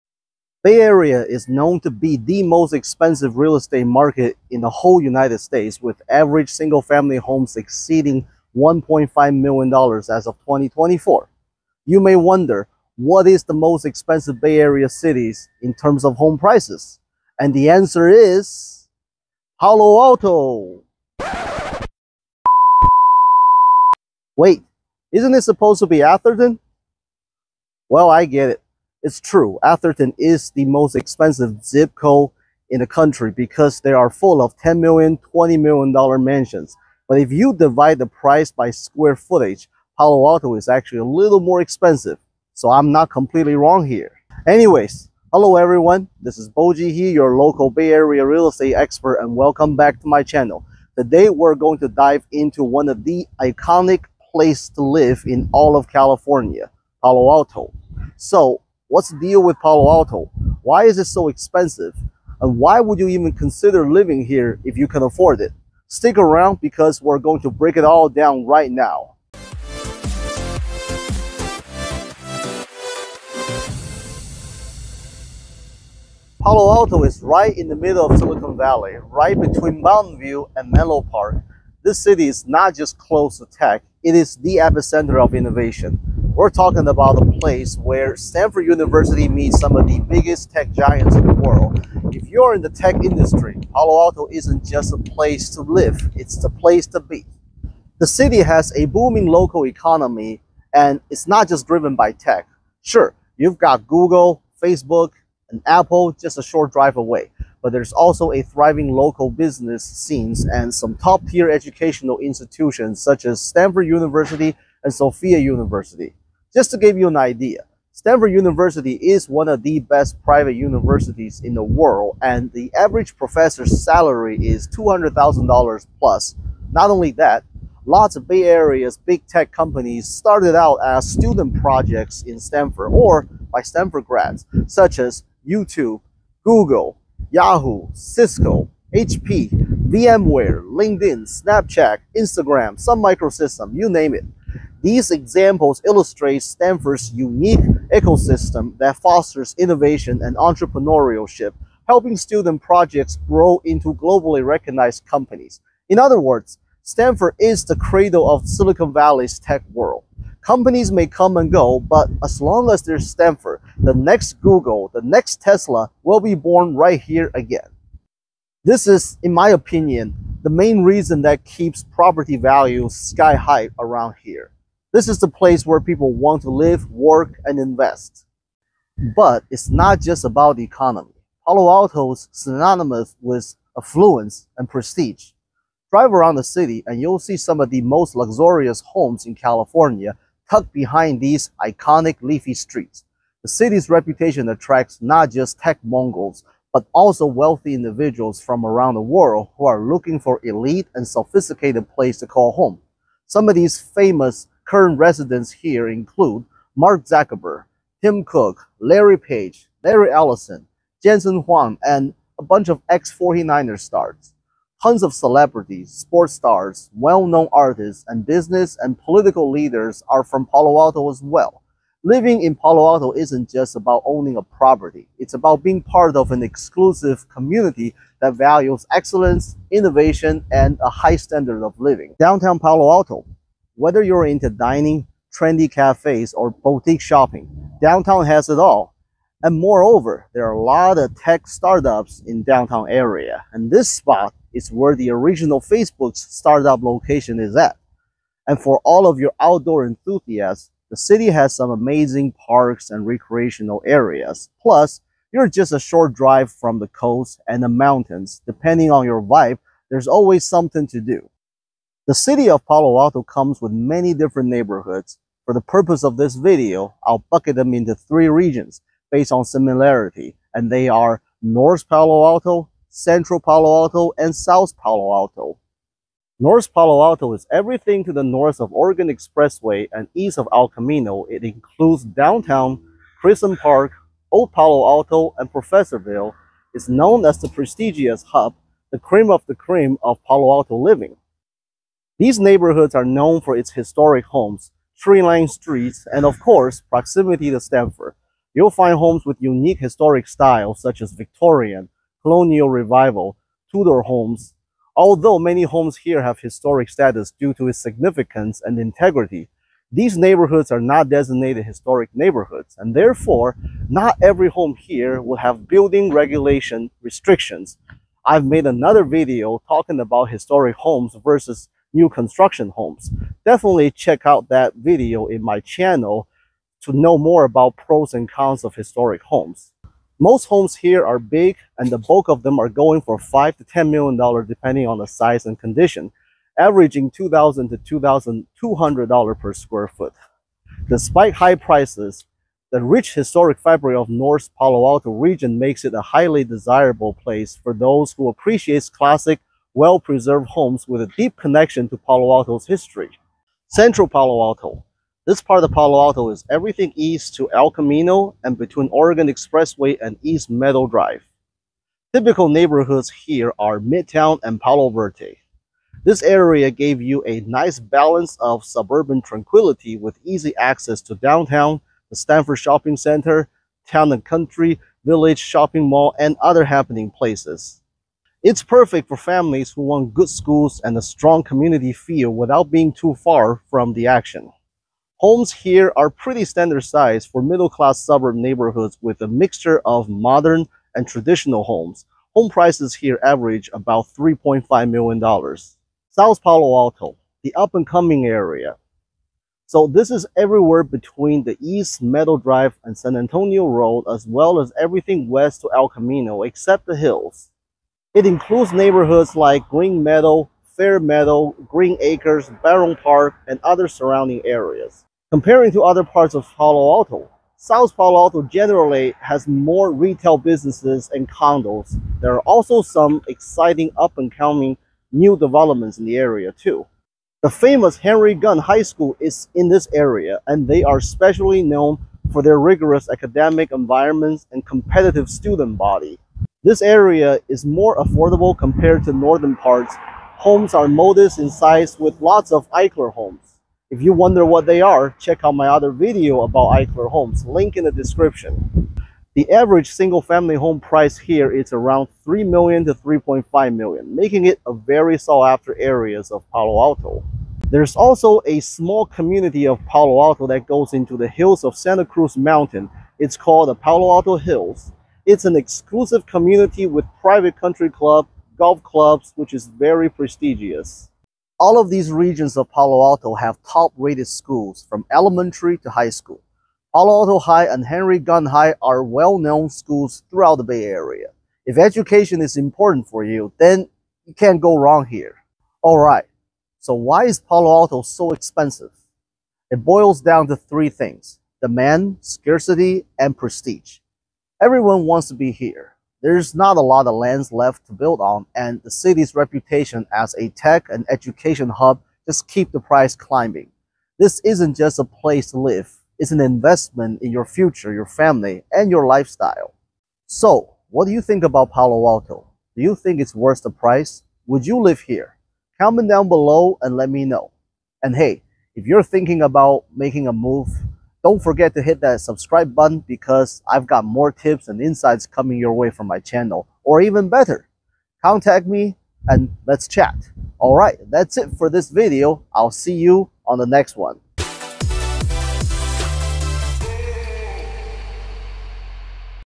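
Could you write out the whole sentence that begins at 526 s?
Or even better, contact me and let's chat.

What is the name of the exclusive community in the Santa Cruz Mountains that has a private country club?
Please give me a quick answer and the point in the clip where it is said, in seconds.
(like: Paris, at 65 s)
Palo Alto Hills, at 463 s.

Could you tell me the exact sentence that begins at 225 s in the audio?
It's about being part of an exclusive community that values excellence, innovation, and a high standard of living.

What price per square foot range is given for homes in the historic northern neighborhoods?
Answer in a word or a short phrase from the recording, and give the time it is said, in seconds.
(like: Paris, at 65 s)
$2,000 to $2,200, at 337 s.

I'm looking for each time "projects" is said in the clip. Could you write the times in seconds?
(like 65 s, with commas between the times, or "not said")
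131 s, 152 s.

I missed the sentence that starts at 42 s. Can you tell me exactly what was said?
So I'm not completely wrong here.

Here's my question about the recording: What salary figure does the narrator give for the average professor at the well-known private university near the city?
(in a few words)
$200,000 plus.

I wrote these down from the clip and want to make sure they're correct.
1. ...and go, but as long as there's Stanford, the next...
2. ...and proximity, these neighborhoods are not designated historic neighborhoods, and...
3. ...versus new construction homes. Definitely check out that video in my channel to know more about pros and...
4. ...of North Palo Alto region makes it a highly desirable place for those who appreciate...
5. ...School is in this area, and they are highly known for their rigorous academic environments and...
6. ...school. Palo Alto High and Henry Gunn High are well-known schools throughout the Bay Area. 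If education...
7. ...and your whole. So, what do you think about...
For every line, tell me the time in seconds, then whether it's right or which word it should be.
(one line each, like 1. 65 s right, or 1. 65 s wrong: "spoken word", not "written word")
1. 161 s right
2. 308 s wrong: "integrity", not "proximity"
3. 321 s right
4. 343 s right
5. 428 s wrong: "specially", not "highly"
6. 476 s right
7. 508 s wrong: "lifestyle", not "whole".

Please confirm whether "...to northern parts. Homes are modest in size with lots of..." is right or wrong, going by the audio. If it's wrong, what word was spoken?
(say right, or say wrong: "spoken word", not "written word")
right.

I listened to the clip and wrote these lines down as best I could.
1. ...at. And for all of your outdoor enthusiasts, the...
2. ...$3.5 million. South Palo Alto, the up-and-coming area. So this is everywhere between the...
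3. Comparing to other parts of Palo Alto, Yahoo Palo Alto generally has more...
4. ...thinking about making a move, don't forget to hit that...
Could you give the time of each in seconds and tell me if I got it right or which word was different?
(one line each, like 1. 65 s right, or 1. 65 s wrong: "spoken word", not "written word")
1. 247 s right
2. 394 s right
3. 415 s wrong: "South", not "Yahoo"
4. 519 s right.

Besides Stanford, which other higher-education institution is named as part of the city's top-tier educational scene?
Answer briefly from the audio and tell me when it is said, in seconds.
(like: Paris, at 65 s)
Sofia University, at 114 s.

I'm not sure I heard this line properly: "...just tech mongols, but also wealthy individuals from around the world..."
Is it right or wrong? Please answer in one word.
right.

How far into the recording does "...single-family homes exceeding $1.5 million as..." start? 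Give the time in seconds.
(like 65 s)
6 s.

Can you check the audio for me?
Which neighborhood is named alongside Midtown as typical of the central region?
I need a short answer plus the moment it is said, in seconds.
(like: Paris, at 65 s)
Palo Verde, at 364 s.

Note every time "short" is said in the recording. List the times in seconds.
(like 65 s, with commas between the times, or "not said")
106 s, 255 s.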